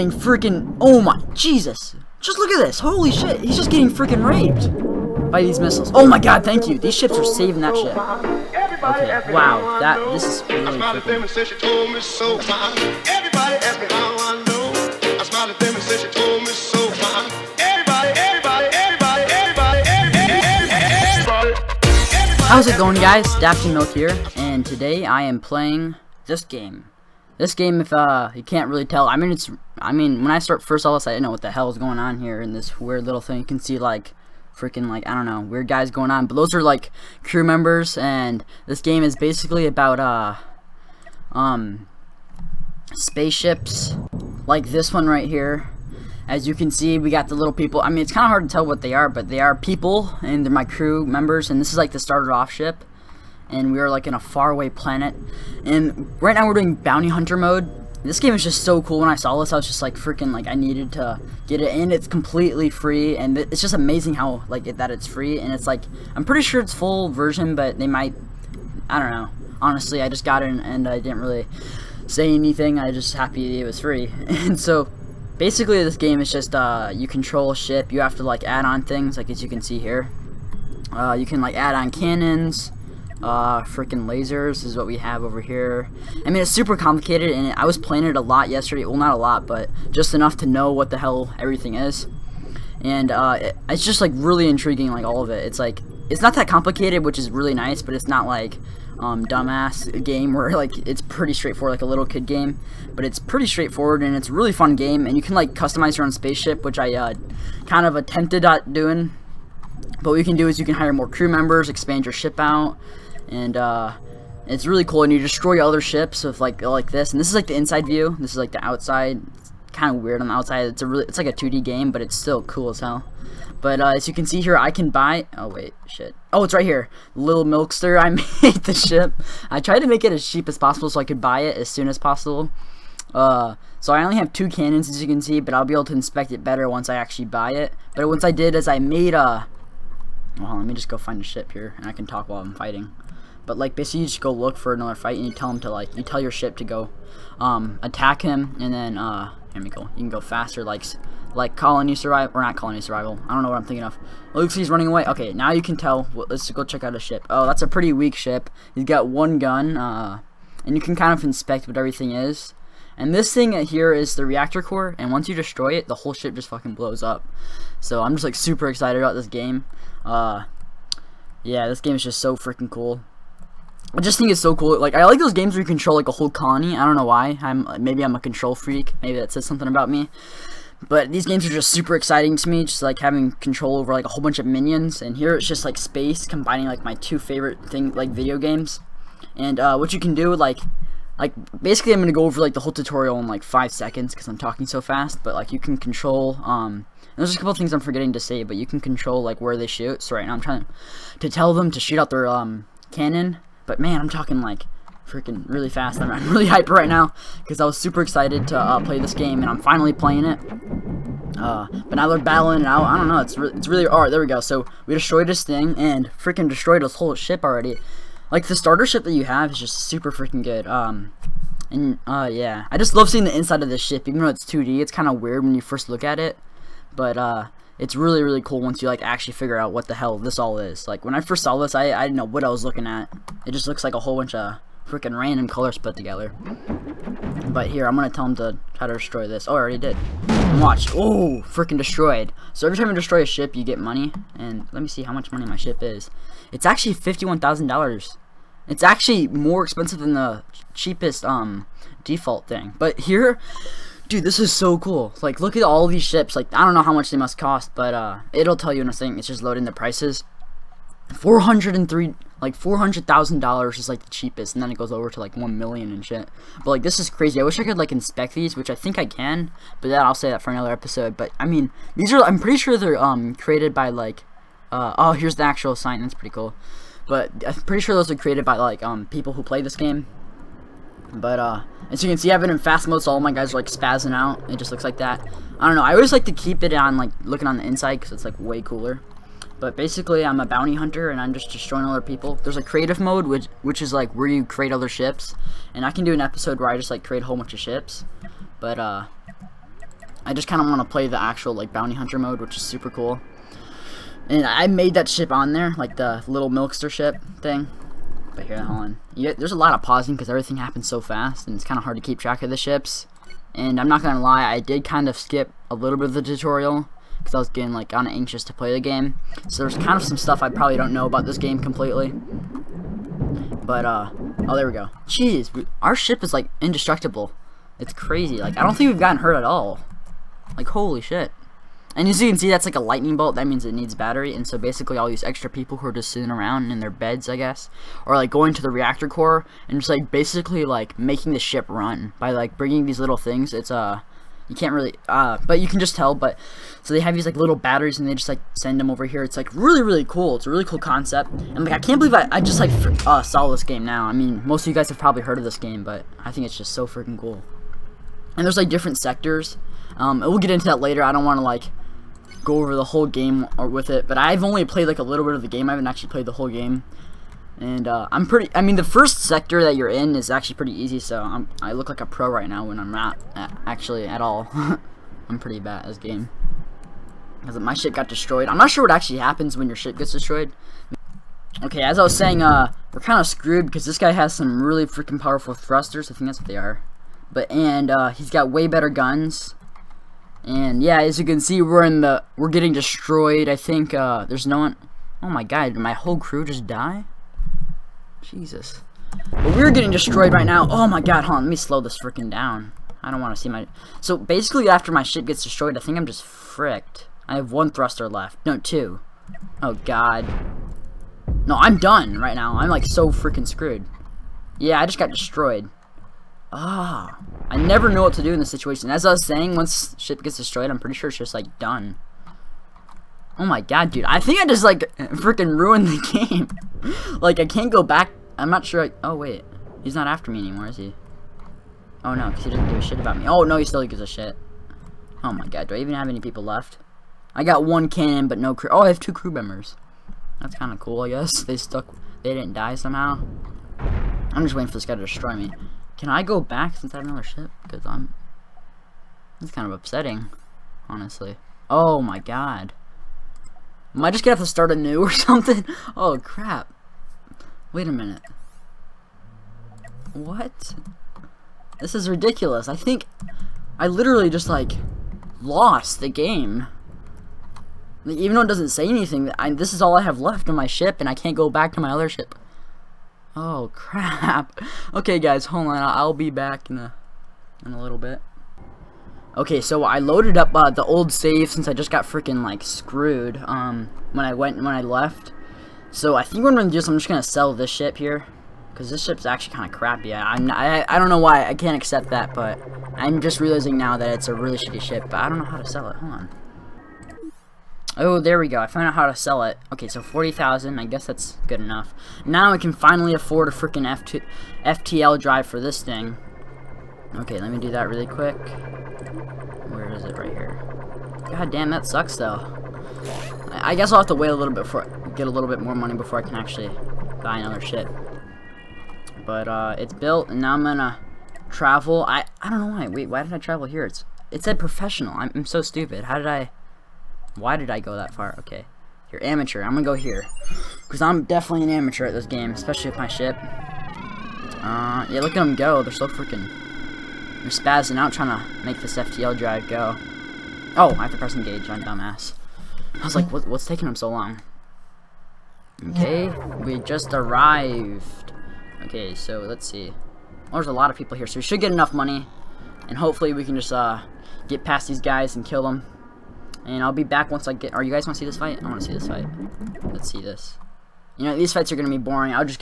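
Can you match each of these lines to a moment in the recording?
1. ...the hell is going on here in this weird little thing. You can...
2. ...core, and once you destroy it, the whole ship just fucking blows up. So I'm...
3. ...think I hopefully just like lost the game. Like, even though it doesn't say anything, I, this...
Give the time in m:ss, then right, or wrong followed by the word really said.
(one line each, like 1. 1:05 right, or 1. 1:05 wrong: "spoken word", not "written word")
1. 0:31 right
2. 2:44 right
3. 7:42 wrong: "literally", not "hopefully".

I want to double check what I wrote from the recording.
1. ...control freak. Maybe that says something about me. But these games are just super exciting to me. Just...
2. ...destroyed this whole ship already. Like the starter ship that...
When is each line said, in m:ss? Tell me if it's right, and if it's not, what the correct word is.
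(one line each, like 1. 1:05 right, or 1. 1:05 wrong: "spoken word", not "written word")
1. 2:58 right
2. 3:36 right.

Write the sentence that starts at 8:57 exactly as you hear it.
They're spazzing out trying to make this FTL drive go.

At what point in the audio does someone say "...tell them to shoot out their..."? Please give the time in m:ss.
3:21.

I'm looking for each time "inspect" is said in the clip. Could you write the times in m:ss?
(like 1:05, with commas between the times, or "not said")
2:15, 2:41, 4:27.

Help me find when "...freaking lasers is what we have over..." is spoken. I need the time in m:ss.
1:23.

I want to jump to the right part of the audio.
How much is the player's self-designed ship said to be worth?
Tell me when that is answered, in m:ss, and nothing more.
4:06.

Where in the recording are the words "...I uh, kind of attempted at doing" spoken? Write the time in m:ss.
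1:46.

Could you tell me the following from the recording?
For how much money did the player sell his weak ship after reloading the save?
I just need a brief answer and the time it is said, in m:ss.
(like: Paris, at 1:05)
40,000, at 8:20.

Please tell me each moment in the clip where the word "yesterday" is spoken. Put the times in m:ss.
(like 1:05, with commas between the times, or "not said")
1:28.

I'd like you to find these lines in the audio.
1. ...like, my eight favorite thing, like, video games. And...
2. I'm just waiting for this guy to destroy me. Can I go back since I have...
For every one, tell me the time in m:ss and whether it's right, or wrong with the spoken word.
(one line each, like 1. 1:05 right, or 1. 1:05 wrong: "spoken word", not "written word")
1. 3:06 wrong: "two", not "eight"
2. 7:23 right.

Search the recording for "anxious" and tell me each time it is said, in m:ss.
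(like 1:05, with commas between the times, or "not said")
5:18.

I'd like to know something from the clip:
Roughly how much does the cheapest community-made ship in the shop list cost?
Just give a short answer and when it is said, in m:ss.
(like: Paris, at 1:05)
$400,000, at 4:22.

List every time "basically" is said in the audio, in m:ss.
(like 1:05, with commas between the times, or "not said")
0:39, 1:15, 2:23, 3:11, 4:49, 5:34, 5:40, 6:44.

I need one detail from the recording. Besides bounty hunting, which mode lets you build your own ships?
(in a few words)
Creative mode.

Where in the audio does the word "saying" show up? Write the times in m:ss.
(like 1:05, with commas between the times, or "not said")
6:22, 6:59.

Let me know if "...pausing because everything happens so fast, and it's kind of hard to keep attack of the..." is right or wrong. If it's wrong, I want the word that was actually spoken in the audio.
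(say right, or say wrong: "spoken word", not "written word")
wrong: "track", not "attack".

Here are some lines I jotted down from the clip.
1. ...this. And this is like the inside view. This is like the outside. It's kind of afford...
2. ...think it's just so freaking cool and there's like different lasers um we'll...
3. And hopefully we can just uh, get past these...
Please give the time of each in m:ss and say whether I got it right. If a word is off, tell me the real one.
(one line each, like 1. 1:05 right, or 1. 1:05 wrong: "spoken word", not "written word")
1. 1:56 wrong: "weird", not "afford"
2. 5:56 wrong: "sectors", not "lasers"
3. 9:12 right.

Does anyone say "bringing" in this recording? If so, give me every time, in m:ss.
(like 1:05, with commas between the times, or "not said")
5:42.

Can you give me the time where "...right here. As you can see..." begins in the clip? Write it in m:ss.
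0:45.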